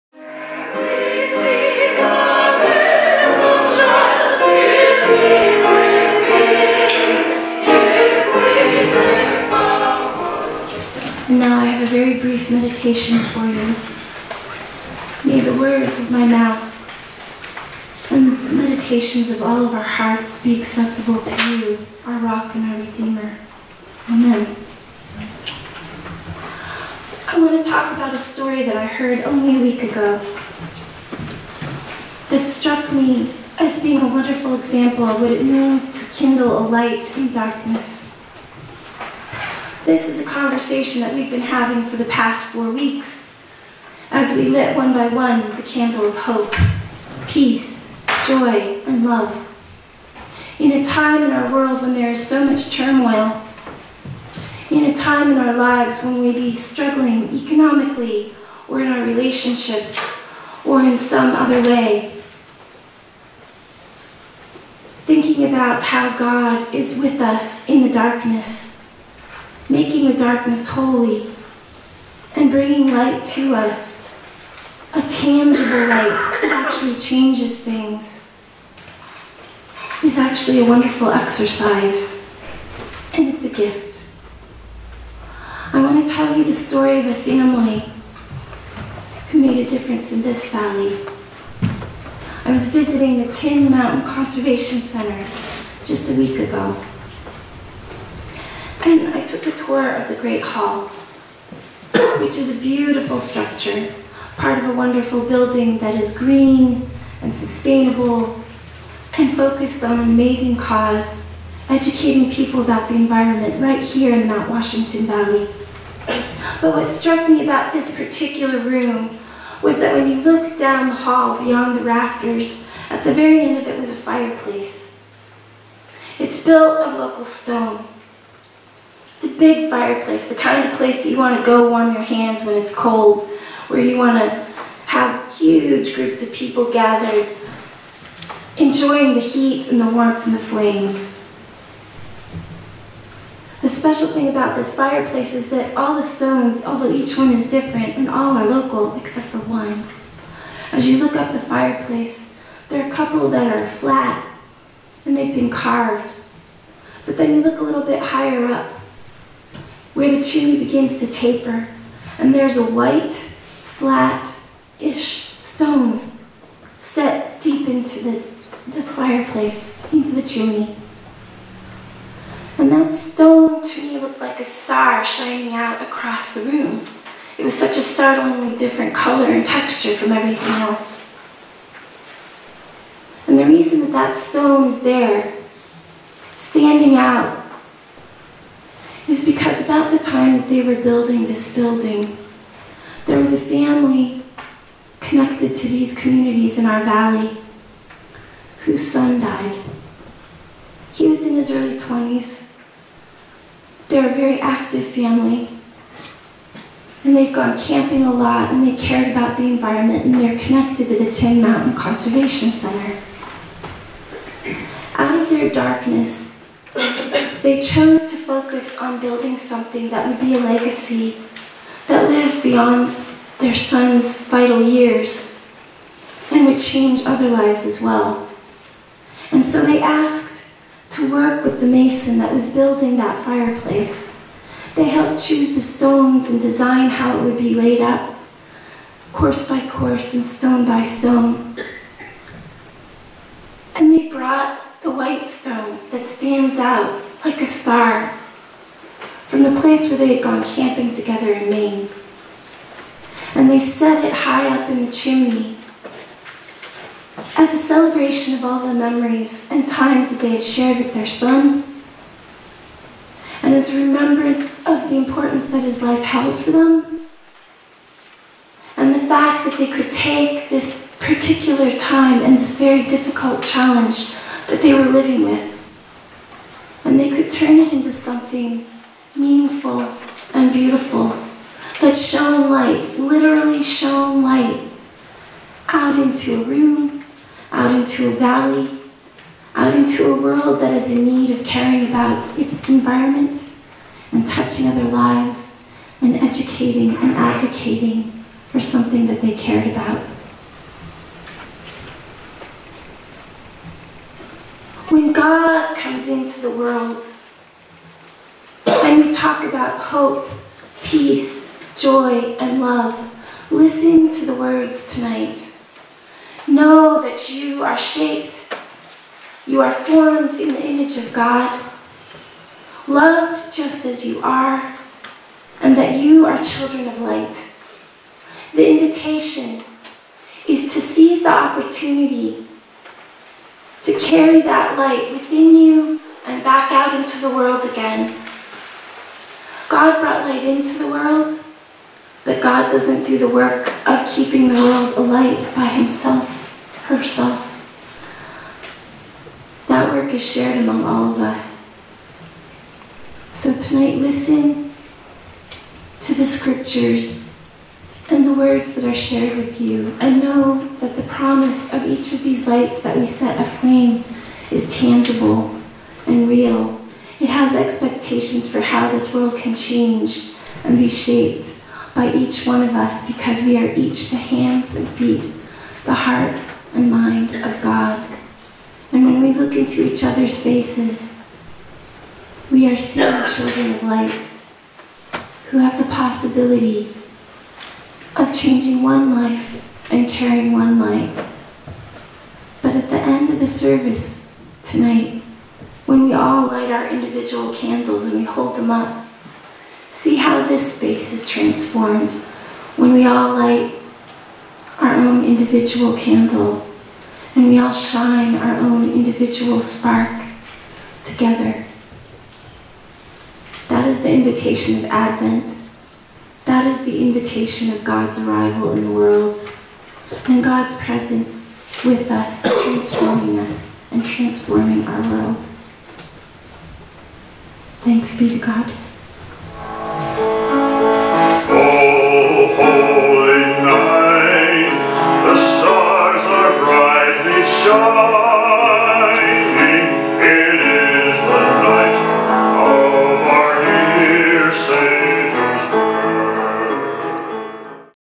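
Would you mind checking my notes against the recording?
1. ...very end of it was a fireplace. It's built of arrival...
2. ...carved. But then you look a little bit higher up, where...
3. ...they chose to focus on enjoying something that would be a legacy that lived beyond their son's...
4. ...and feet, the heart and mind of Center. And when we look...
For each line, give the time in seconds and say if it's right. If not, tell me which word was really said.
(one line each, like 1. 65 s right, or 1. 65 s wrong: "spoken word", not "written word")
1. 123 s wrong: "local", not "arrival"
2. 155 s right
3. 216 s wrong: "building", not "enjoying"
4. 374 s wrong: "God", not "Center".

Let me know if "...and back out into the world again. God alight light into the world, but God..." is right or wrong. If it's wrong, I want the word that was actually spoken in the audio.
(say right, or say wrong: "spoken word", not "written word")
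wrong: "brought", not "alight".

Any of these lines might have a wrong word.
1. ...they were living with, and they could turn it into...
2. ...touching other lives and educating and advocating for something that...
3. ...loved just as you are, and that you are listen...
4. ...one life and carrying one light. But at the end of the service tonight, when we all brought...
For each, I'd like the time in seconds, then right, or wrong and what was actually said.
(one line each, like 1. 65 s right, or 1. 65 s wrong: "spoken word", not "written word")
1. 274 s right
2. 294 s right
3. 322 s wrong: "children", not "listen"
4. 388 s wrong: "light", not "brought".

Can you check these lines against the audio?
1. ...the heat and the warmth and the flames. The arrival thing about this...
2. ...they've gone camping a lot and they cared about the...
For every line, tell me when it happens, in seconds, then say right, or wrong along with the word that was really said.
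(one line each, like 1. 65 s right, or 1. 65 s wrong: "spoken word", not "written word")
1. 139 s wrong: "special", not "arrival"
2. 207 s right.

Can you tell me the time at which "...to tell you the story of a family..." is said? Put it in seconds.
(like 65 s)
86 s.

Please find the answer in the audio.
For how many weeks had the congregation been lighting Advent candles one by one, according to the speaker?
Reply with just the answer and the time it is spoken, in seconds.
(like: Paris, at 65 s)
4, at 42 s.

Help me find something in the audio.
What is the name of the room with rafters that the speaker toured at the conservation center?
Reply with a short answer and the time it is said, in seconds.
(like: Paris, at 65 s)
The Great Hall, at 100 s.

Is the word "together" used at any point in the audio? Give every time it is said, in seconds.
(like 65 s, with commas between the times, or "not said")
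250 s, 411 s.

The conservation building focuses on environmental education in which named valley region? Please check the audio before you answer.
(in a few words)
Mount Washington Valley.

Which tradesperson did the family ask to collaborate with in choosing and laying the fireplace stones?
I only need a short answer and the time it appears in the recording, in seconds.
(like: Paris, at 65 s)
The mason, at 231 s.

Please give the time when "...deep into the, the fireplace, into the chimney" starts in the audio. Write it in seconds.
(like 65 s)
167 s.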